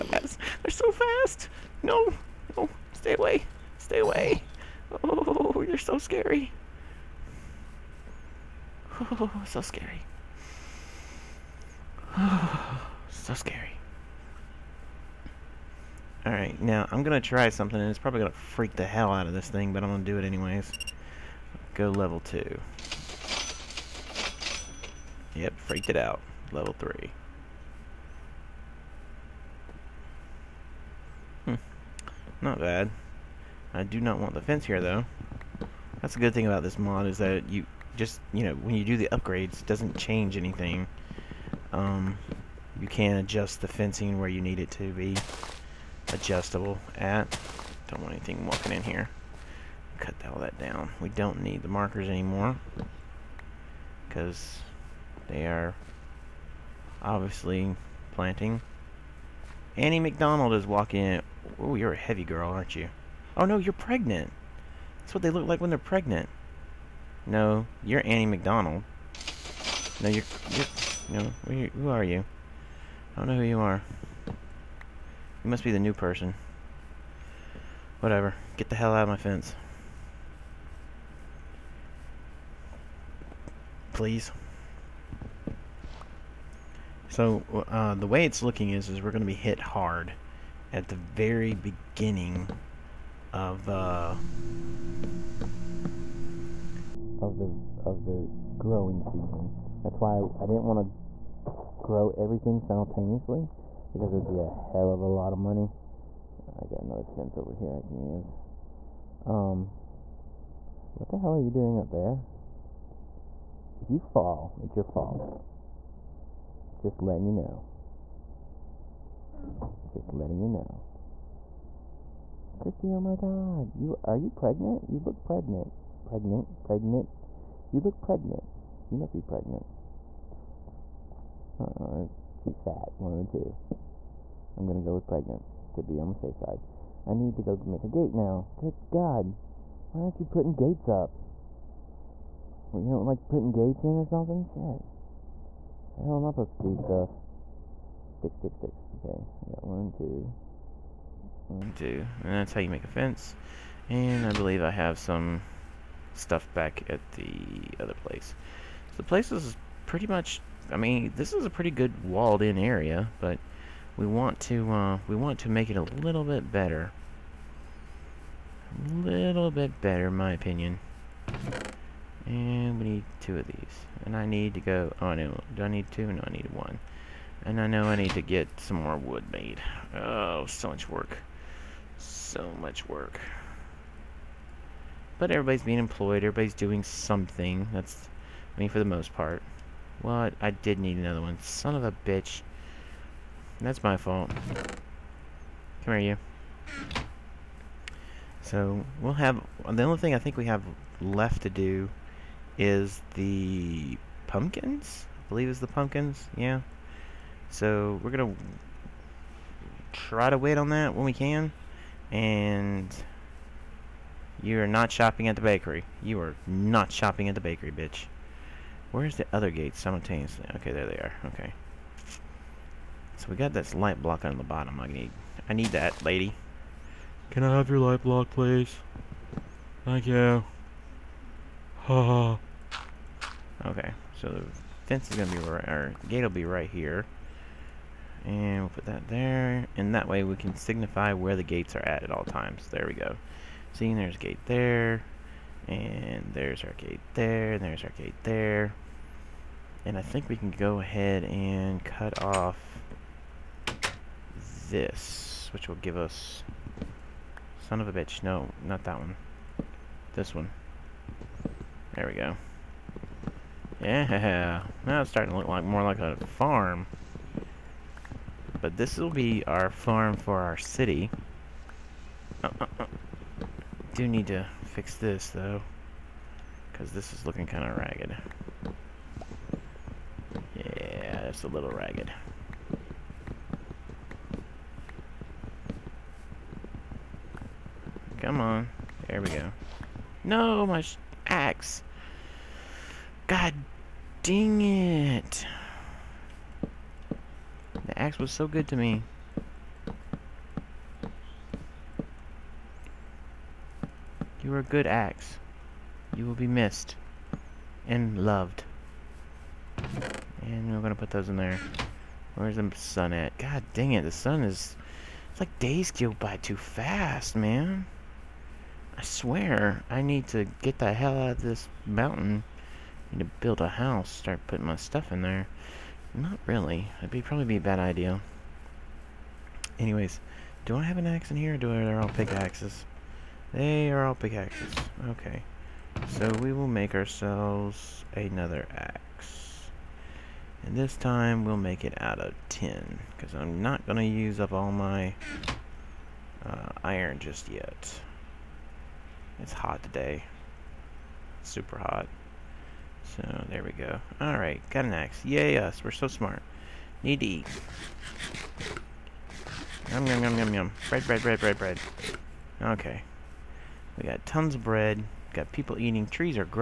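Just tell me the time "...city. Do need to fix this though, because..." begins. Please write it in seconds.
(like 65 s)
270 s.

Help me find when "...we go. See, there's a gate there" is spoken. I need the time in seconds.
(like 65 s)
242 s.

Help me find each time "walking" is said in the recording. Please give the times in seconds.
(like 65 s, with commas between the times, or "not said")
48 s, 60 s.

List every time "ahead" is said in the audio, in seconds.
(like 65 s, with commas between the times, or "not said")
250 s.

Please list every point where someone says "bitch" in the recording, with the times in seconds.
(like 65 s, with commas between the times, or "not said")
192 s, 217 s, 257 s.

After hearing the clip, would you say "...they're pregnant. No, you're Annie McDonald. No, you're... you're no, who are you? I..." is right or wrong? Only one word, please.
right.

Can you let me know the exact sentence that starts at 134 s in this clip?
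I'm gonna go with pregnant to be on the safe side.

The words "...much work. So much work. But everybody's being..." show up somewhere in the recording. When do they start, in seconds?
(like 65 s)
180 s.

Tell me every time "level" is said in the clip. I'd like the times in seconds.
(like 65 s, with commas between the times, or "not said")
21 s, 26 s.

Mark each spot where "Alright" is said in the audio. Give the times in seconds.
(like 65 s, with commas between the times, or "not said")
16 s, 354 s.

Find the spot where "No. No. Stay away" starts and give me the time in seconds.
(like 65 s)
1 s.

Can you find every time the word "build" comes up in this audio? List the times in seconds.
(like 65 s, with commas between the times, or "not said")
323 s.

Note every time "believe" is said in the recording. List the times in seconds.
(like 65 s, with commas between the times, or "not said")
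154 s, 205 s.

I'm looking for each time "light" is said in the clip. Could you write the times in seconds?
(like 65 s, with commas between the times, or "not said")
223 s, 227 s.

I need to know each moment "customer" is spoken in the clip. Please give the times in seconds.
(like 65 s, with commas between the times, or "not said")
not said.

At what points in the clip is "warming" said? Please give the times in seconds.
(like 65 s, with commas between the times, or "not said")
not said.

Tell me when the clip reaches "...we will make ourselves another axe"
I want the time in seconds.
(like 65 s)
336 s.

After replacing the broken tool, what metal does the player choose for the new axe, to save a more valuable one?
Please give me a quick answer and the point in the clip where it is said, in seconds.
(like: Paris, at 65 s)
Tin, at 342 s.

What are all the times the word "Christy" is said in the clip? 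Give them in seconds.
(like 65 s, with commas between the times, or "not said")
122 s.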